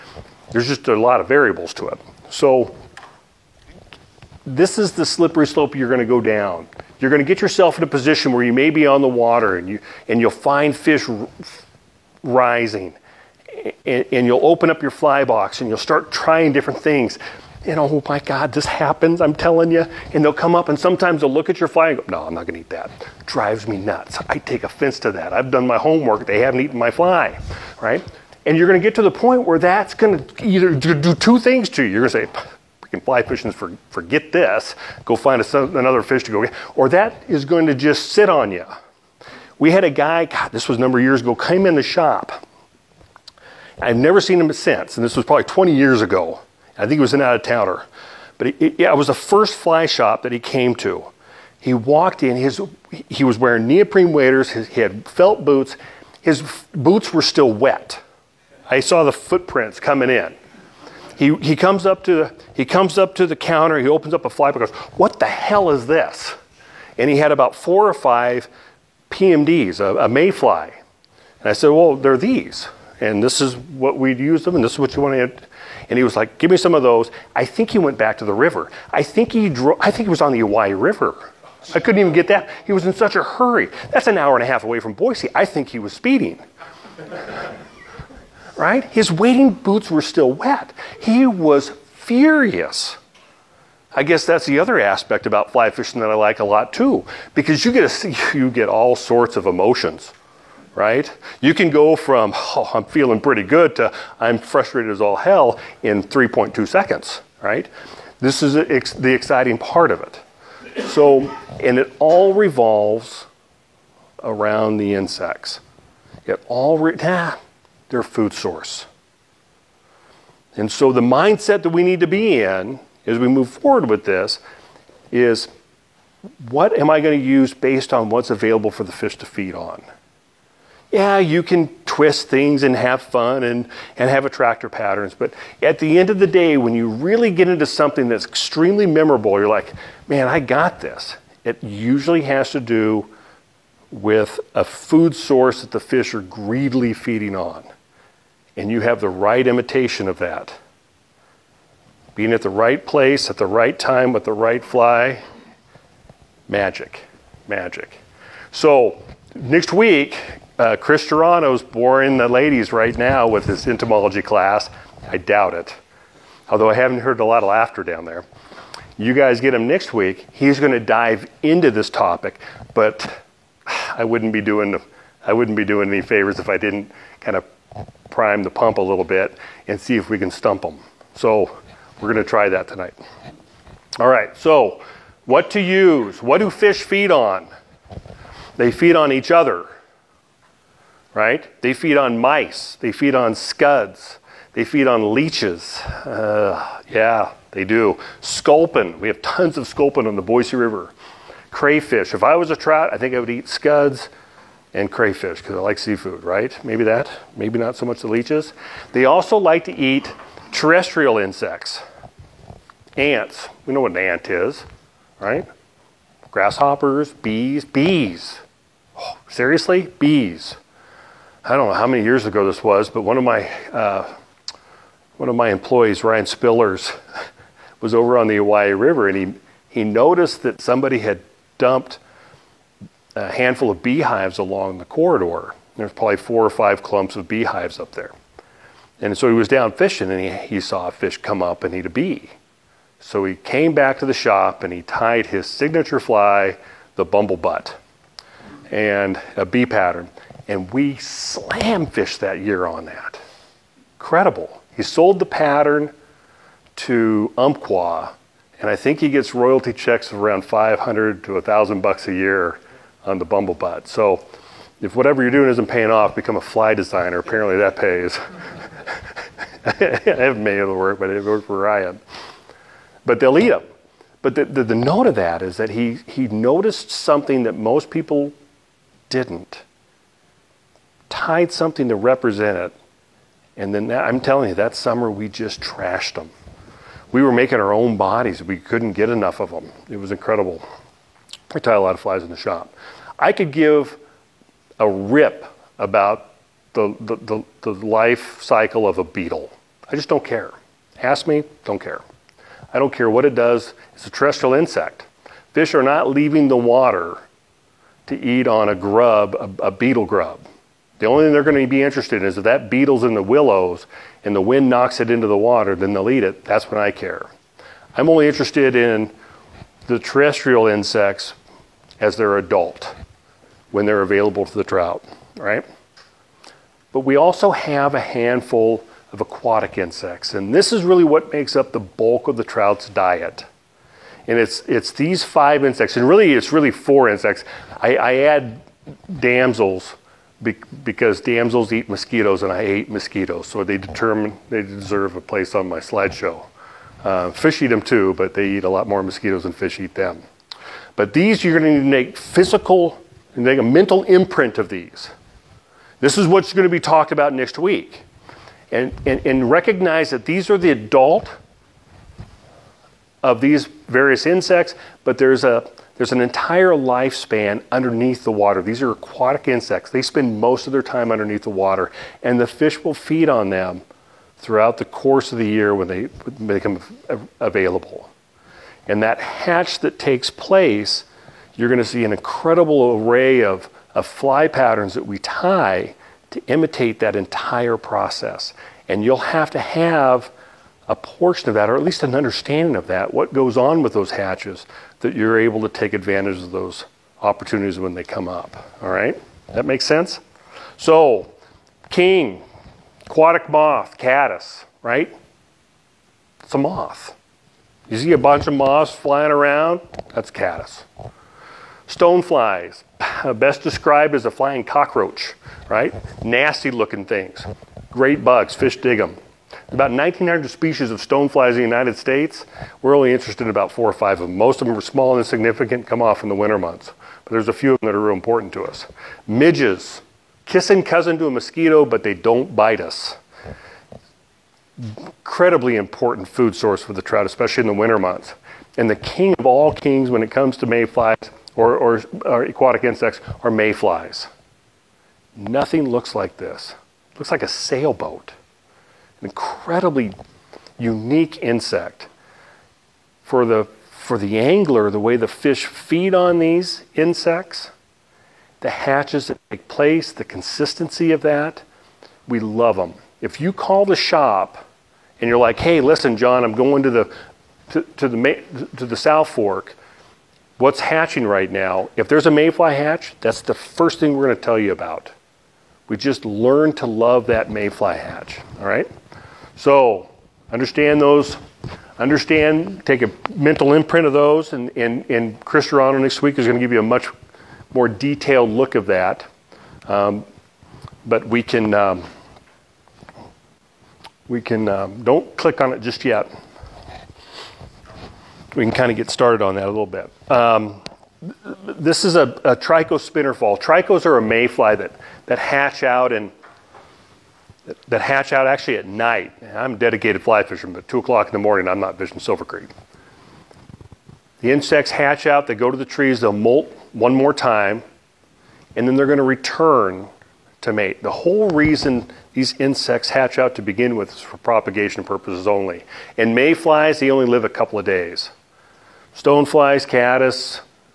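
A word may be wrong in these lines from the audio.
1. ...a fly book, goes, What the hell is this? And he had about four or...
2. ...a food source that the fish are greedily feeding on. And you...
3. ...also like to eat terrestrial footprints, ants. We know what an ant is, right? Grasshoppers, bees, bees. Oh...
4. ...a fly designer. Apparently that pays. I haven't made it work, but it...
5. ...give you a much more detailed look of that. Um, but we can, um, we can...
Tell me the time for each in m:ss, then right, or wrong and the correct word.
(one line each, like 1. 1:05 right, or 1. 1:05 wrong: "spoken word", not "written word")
1. 1:04 right
2. 2:24 right
3. 3:29 wrong: "insects", not "footprints"
4. 4:26 right
5. 8:06 right.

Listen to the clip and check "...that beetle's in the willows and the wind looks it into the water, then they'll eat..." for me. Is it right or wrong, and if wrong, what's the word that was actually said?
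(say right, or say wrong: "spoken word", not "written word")
wrong: "knocks", not "looks".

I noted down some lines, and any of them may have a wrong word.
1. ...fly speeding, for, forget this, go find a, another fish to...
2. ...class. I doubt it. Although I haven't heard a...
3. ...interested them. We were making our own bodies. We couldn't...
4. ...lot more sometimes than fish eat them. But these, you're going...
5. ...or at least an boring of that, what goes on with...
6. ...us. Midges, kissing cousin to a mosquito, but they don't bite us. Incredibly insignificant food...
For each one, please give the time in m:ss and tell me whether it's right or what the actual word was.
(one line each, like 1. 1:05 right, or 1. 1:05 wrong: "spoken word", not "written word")
1. 0:33 wrong: "fishing", not "speeding"
2. 2:44 right
3. 4:45 wrong: "trashed", not "interested"
4. 5:48 wrong: "mosquitoes", not "sometimes"
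5. 6:31 wrong: "understanding", not "boring"
6. 7:08 wrong: "important", not "insignificant".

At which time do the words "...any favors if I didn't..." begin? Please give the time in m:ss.
2:55.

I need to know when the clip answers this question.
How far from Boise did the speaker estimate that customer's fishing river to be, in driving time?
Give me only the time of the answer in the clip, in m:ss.
1:24.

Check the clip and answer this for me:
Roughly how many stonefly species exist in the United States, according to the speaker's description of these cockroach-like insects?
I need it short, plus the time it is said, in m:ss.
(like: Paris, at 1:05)
1,900, at 6:59.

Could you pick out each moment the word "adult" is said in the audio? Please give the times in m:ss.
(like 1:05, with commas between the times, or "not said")
5:22, 6:00.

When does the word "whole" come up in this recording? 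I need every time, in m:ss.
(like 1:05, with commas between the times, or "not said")
8:41.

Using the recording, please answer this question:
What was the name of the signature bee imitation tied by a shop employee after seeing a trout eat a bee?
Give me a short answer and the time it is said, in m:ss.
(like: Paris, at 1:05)
bumble butt, at 4:06.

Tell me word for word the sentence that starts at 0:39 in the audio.
We had a guy, God, this was a number of years ago, came in the shop.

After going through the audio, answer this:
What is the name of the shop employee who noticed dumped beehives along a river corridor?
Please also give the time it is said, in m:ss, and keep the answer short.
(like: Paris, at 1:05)
Ryan Spillers, at 3:46.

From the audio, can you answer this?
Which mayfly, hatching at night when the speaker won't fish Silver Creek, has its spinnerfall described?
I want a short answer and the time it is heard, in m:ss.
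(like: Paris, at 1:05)
Tricho, at 8:22.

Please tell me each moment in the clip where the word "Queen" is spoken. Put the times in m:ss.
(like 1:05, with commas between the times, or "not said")
not said.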